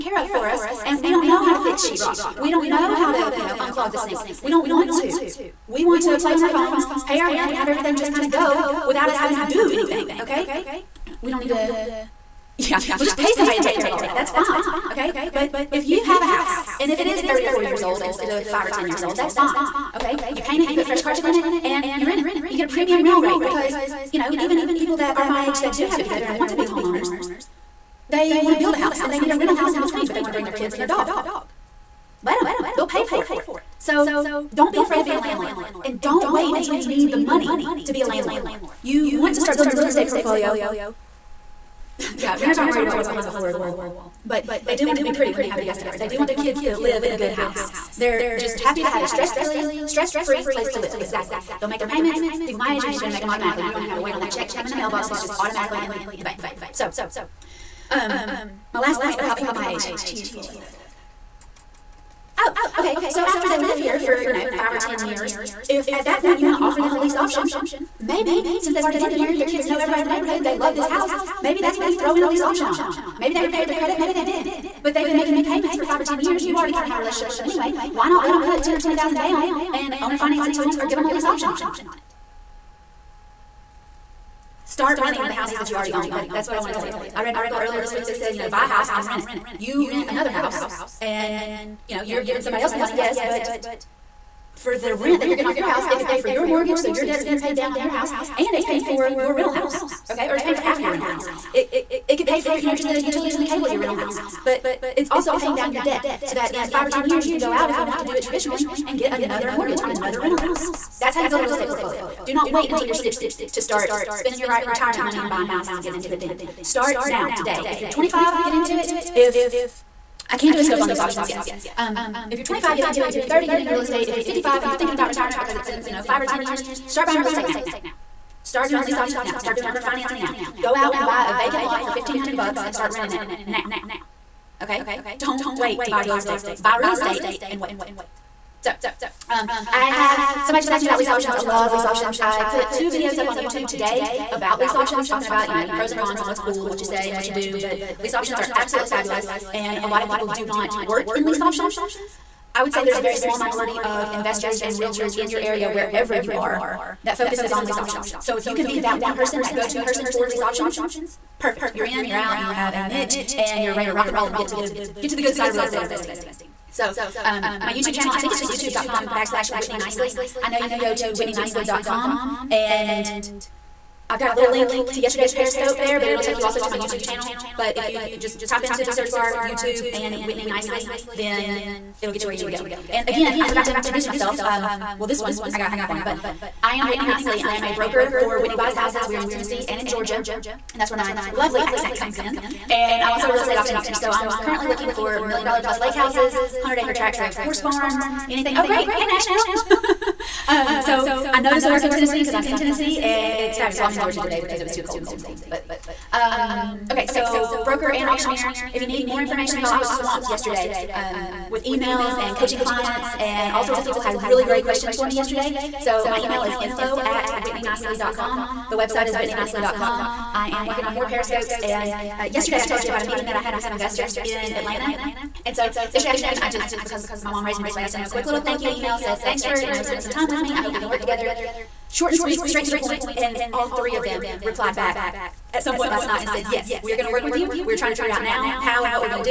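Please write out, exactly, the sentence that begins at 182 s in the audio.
And again, I forgot to introduce myself.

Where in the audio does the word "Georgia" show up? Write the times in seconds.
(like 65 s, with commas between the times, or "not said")
189 s, 203 s.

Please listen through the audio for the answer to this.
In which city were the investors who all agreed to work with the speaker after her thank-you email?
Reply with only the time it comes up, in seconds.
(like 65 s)
224 s.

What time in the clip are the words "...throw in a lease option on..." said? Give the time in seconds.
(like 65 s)
71 s.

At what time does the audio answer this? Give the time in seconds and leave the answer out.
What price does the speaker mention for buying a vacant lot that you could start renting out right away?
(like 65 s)
131 s.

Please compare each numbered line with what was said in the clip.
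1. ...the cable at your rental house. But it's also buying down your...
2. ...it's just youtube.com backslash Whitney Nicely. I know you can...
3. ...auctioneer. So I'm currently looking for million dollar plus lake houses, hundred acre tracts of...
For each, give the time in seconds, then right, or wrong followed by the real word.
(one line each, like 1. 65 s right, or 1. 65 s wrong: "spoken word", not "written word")
1. 103 s wrong: "paying", not "buying"
2. 168 s right
3. 193 s right.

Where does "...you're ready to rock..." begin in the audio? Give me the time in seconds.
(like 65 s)
163 s.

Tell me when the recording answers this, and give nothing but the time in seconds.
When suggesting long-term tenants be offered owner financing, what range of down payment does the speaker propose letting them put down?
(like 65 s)
78 s.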